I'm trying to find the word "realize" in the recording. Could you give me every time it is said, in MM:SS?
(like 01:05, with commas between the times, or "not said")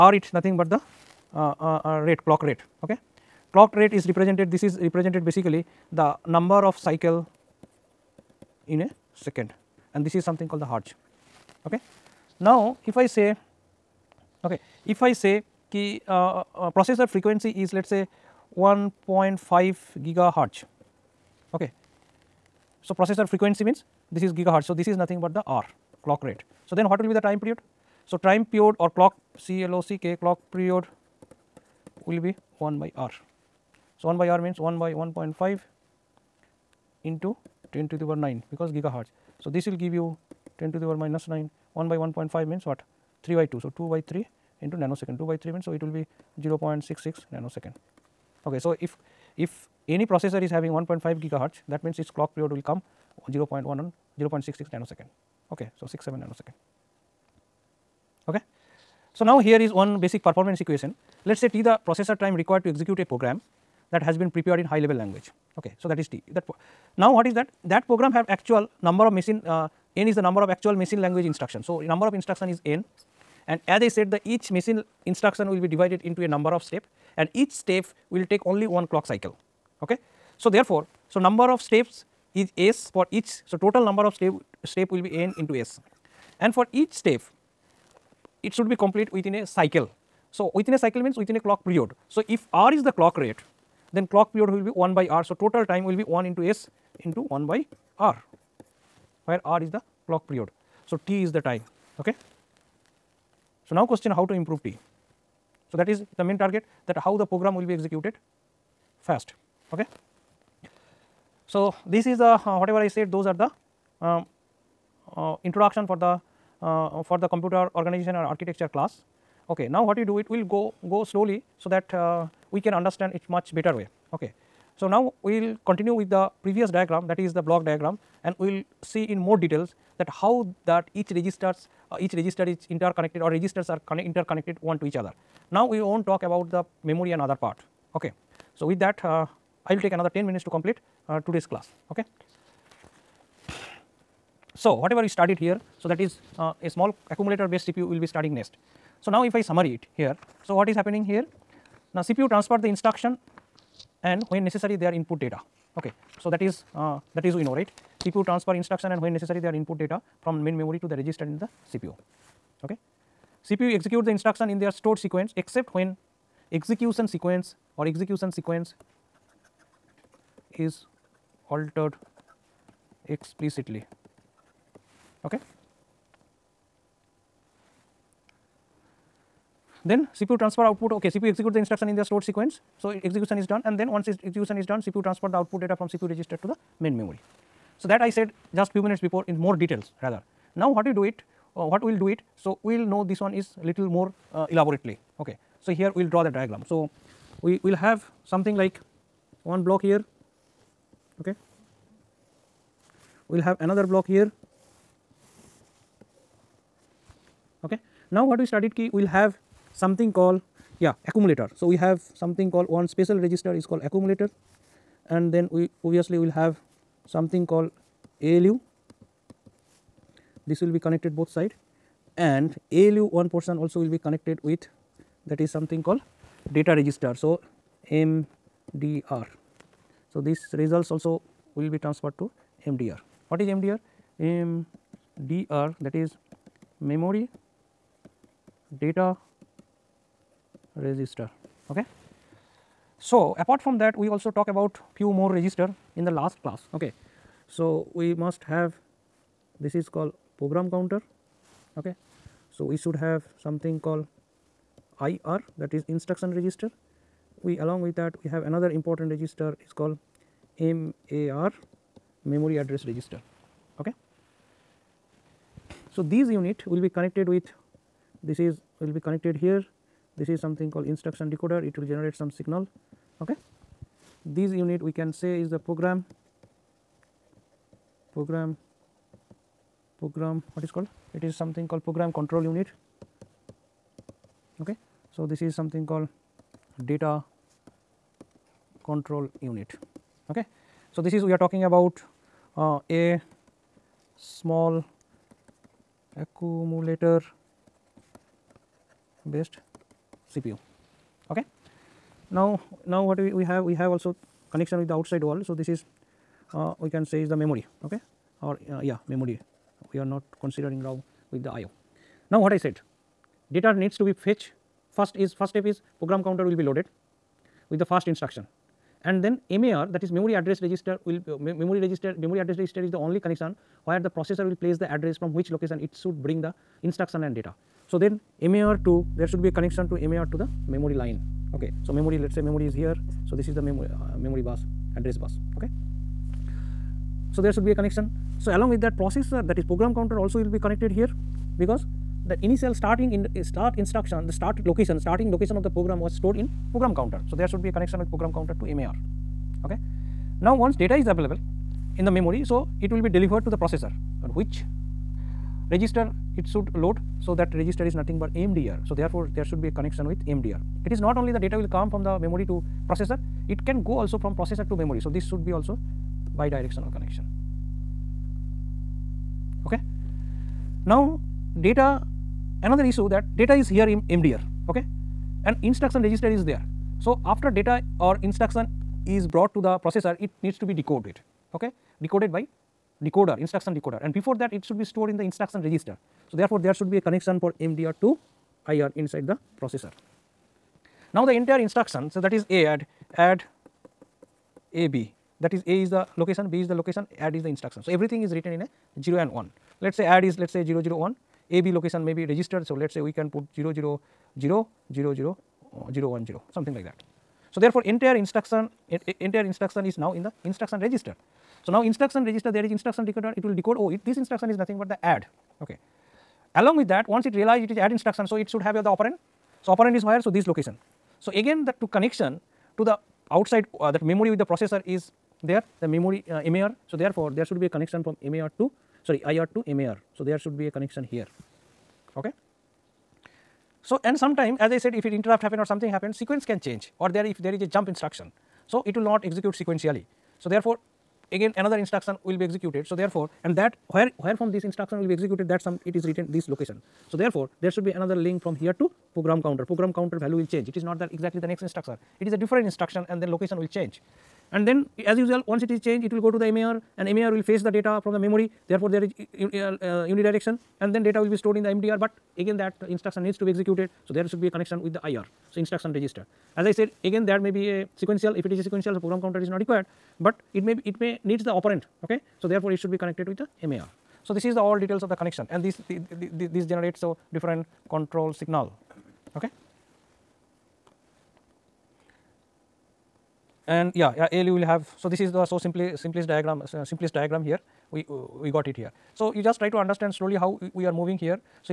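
06:57.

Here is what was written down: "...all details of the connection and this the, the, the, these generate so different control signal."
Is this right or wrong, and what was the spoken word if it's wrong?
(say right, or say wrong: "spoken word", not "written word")
right.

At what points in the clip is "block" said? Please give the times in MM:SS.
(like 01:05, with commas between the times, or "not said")
02:07, 03:19, 03:23.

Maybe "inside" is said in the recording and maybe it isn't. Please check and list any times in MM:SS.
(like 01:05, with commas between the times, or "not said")
06:28.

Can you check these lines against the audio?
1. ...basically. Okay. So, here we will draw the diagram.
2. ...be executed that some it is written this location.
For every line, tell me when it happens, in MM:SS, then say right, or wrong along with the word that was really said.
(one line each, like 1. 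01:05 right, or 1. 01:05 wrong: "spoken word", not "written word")
1. 03:14 wrong: "elaborately", not "basically"
2. 07:25 right.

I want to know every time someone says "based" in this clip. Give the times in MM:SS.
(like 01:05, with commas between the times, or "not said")
02:27, 04:59.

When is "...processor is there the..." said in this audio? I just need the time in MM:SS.
07:04.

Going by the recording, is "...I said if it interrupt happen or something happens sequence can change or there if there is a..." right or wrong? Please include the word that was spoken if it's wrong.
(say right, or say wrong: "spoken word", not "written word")
right.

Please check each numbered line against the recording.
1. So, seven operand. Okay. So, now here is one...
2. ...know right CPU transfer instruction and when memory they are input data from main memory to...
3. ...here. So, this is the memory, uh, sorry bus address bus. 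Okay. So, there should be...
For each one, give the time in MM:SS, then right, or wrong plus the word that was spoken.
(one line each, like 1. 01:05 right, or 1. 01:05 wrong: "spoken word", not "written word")
1. 00:55 wrong: "nanosecond", not "operand"
2. 02:37 wrong: "necessary", not "memory"
3. 05:32 wrong: "memory", not "sorry".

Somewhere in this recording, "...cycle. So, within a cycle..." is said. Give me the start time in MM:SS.
01:29.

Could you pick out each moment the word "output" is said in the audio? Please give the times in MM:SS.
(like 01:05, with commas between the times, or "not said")
03:00, 03:05.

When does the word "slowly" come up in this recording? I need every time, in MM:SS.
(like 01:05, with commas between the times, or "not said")
02:01, 08:10.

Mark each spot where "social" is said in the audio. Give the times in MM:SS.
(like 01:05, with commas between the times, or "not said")
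not said.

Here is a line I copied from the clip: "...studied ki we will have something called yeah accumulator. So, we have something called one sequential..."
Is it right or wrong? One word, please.
wrong.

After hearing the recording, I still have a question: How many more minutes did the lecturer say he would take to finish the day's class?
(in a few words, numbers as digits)
10 minutes.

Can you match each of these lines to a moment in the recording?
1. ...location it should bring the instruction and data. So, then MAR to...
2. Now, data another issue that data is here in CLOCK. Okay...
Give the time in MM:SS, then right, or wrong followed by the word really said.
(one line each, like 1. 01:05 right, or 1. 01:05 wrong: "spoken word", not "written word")
1. 05:25 right
2. 06:10 wrong: "MDR", not "CLOCK".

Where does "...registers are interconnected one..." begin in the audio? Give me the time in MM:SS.
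02:13.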